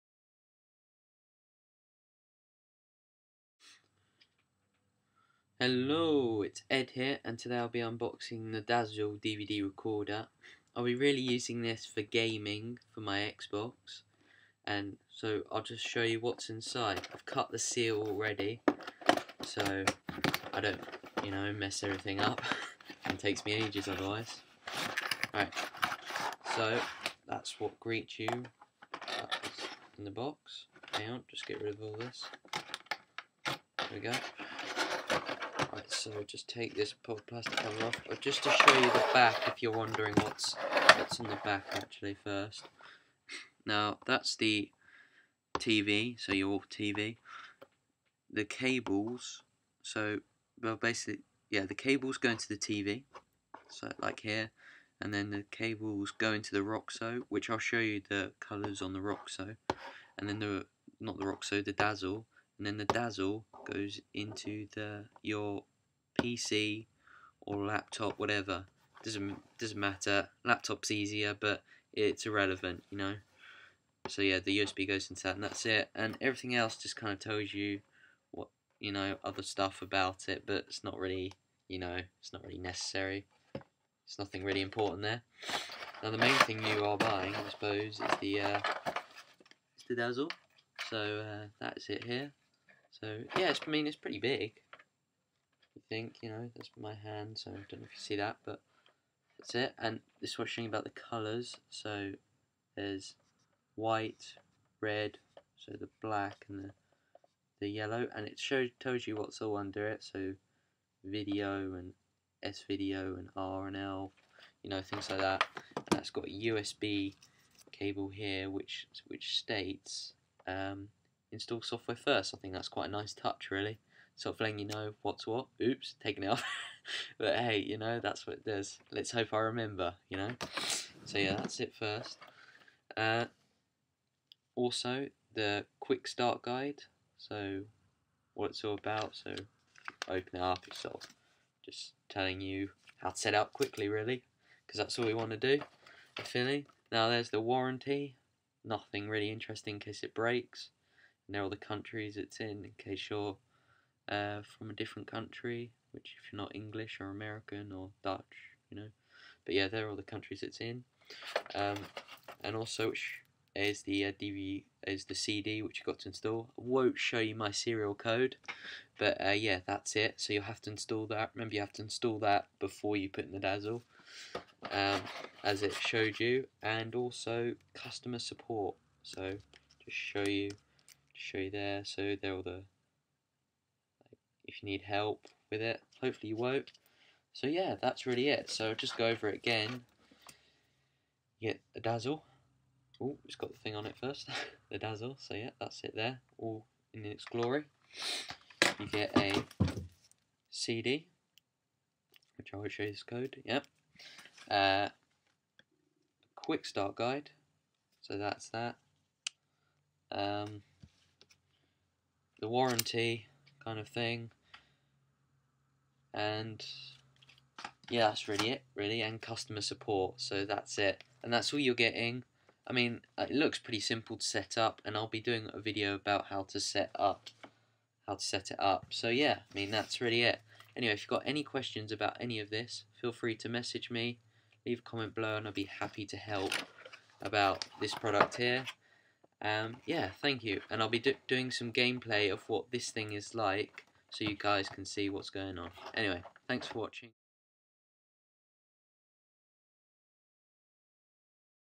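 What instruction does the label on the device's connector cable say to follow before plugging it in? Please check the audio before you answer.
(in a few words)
Install software first.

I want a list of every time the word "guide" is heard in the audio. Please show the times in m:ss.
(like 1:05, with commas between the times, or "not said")
2:16, 3:26.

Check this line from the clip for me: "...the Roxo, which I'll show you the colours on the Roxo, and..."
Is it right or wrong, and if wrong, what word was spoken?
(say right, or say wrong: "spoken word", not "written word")
right.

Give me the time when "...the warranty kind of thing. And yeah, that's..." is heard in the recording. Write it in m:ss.
3:32.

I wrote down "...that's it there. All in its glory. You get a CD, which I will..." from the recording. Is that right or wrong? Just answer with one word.
right.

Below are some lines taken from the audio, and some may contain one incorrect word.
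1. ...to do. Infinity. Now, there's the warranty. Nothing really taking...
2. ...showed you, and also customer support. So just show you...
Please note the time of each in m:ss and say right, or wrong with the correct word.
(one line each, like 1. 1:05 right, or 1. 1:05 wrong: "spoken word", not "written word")
1. 2:25 wrong: "interesting", not "taking"
2. 2:55 right.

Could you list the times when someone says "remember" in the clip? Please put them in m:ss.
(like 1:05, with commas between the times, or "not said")
2:09, 2:51.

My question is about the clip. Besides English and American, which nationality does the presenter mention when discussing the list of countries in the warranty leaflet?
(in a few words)
Dutch.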